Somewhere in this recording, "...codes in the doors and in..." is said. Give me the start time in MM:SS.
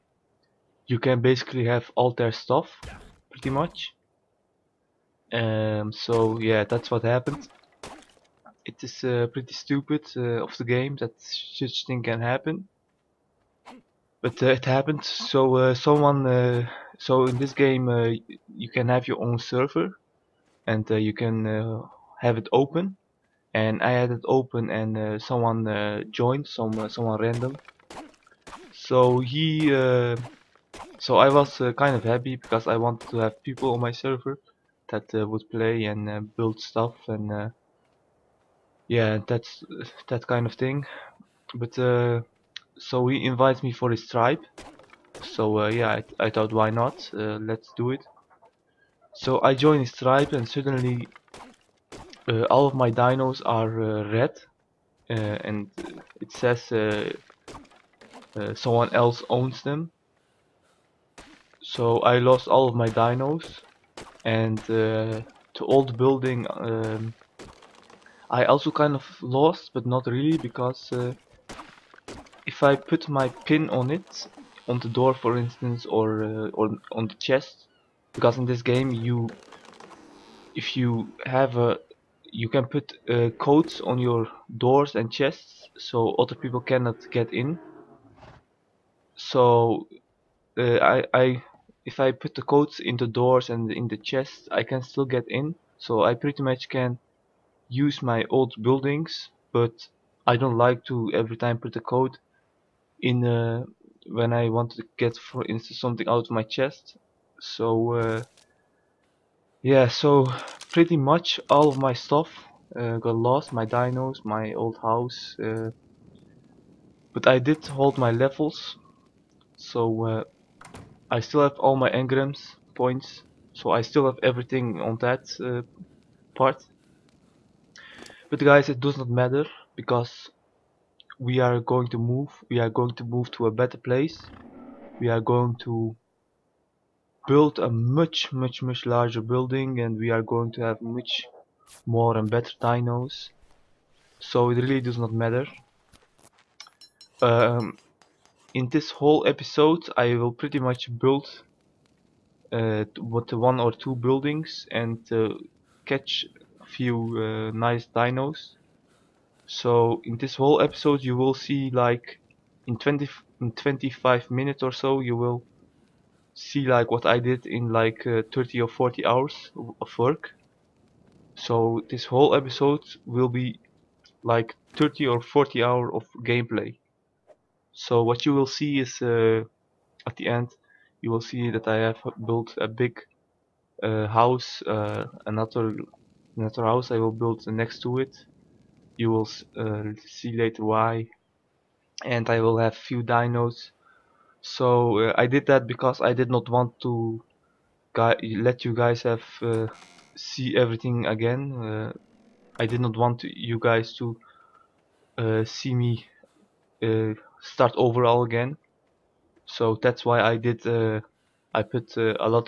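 01:32.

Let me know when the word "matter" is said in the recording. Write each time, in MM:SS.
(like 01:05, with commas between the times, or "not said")
02:09, 02:25.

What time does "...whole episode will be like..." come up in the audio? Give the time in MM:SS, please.
02:52.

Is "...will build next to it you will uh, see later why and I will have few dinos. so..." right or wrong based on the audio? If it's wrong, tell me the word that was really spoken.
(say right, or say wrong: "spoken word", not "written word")
right.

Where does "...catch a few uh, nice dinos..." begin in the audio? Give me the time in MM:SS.
02:35.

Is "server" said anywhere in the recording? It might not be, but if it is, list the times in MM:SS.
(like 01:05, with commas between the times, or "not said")
00:19, 00:33.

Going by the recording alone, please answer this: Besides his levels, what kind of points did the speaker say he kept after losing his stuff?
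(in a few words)
engrams points.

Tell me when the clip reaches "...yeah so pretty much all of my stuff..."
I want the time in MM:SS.
01:49.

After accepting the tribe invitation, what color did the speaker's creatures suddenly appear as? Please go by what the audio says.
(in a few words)
red.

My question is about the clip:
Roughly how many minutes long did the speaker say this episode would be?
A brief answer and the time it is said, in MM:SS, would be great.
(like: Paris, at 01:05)
25, at 02:43.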